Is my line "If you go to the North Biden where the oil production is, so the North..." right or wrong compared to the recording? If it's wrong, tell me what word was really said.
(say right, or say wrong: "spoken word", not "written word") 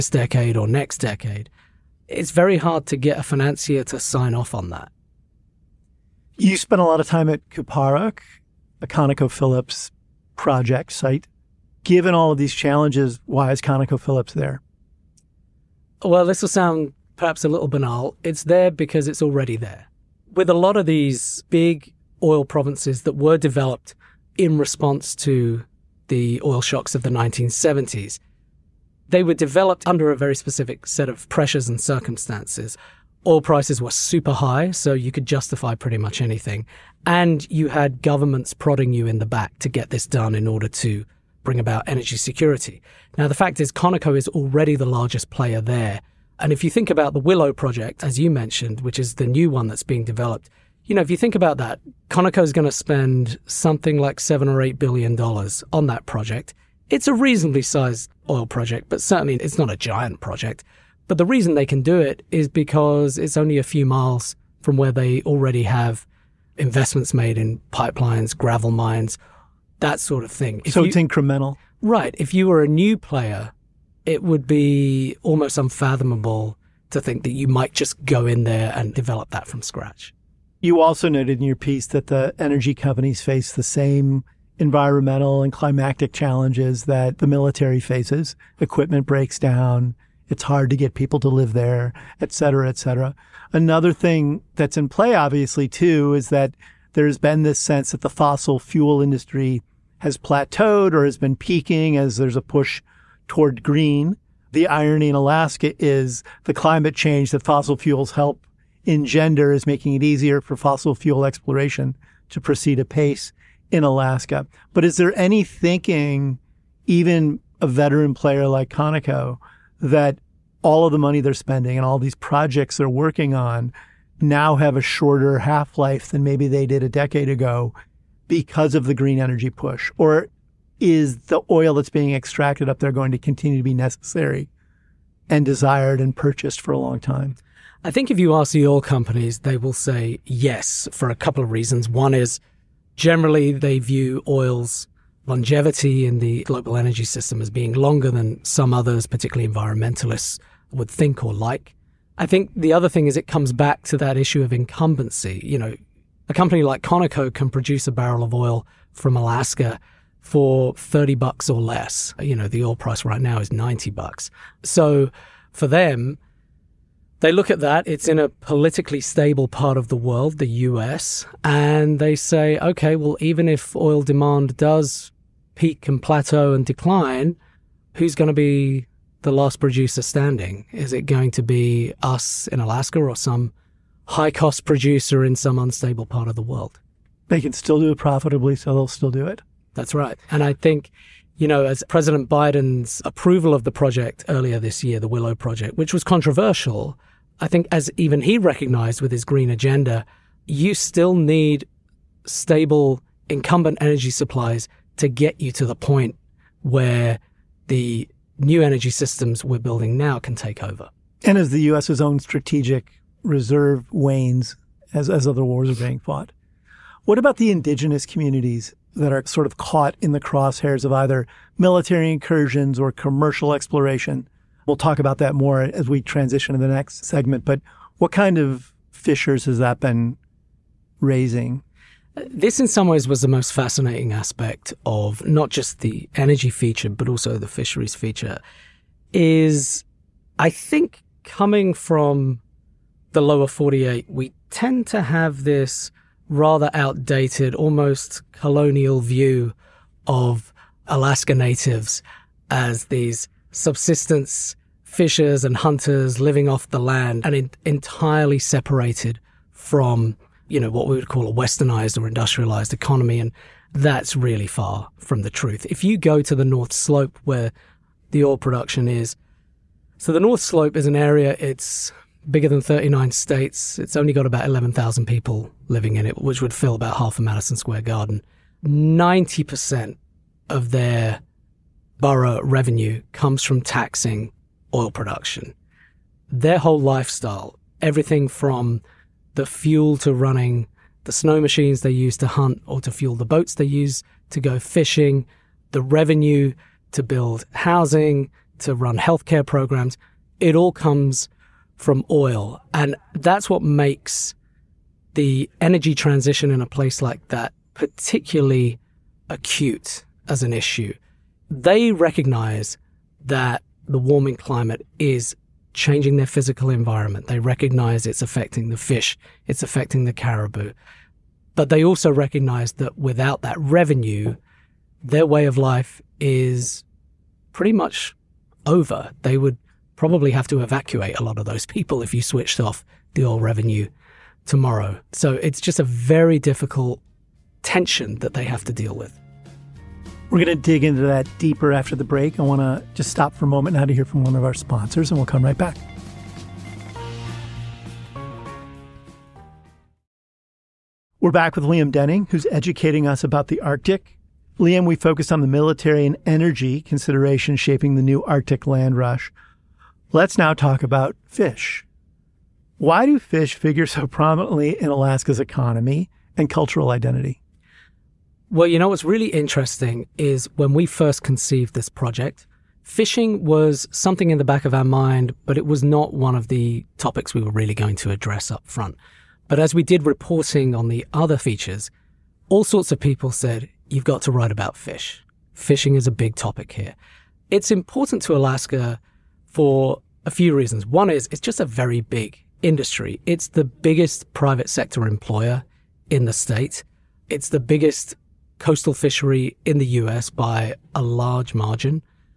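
wrong: "Slope", not "Biden".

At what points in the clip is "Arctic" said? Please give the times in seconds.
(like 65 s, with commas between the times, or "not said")
353 s, 358 s.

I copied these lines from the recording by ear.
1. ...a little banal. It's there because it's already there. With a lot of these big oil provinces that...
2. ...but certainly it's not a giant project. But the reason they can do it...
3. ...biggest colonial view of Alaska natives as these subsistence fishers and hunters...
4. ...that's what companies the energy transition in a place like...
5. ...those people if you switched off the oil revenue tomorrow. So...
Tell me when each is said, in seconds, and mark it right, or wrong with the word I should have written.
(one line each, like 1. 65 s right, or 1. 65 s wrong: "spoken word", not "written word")
1. 17 s right
2. 58 s right
3. 247 s wrong: "almost", not "biggest"
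4. 303 s wrong: "makes", not "companies"
5. 331 s right.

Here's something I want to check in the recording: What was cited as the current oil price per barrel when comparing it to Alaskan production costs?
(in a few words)
$90.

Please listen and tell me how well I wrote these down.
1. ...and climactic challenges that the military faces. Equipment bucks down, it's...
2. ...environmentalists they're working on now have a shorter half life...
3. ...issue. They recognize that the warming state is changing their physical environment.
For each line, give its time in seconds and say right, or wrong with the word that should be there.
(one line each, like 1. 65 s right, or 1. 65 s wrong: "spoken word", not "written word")
1. 85 s wrong: "breaks", not "bucks"
2. 122 s wrong: "projects", not "environmentalists"
3. 310 s wrong: "climate", not "state".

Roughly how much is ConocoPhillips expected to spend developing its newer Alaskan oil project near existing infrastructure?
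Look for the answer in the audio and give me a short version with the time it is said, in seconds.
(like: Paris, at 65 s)
7 or 8 billion dollars, at 54 s.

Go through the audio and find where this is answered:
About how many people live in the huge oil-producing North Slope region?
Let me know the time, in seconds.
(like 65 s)
274 s.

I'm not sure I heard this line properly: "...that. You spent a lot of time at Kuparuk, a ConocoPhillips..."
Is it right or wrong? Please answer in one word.
right.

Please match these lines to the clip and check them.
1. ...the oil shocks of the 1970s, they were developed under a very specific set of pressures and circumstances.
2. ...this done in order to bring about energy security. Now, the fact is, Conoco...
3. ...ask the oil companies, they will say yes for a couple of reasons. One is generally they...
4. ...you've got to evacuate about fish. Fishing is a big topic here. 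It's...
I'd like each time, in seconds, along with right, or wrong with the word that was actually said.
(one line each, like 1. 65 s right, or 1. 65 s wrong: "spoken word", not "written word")
1. 26 s right
2. 39 s right
3. 138 s right
4. 383 s wrong: "write", not "evacuate".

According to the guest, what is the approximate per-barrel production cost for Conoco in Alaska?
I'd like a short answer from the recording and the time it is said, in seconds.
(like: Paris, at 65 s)
$30 or less, at 160 s.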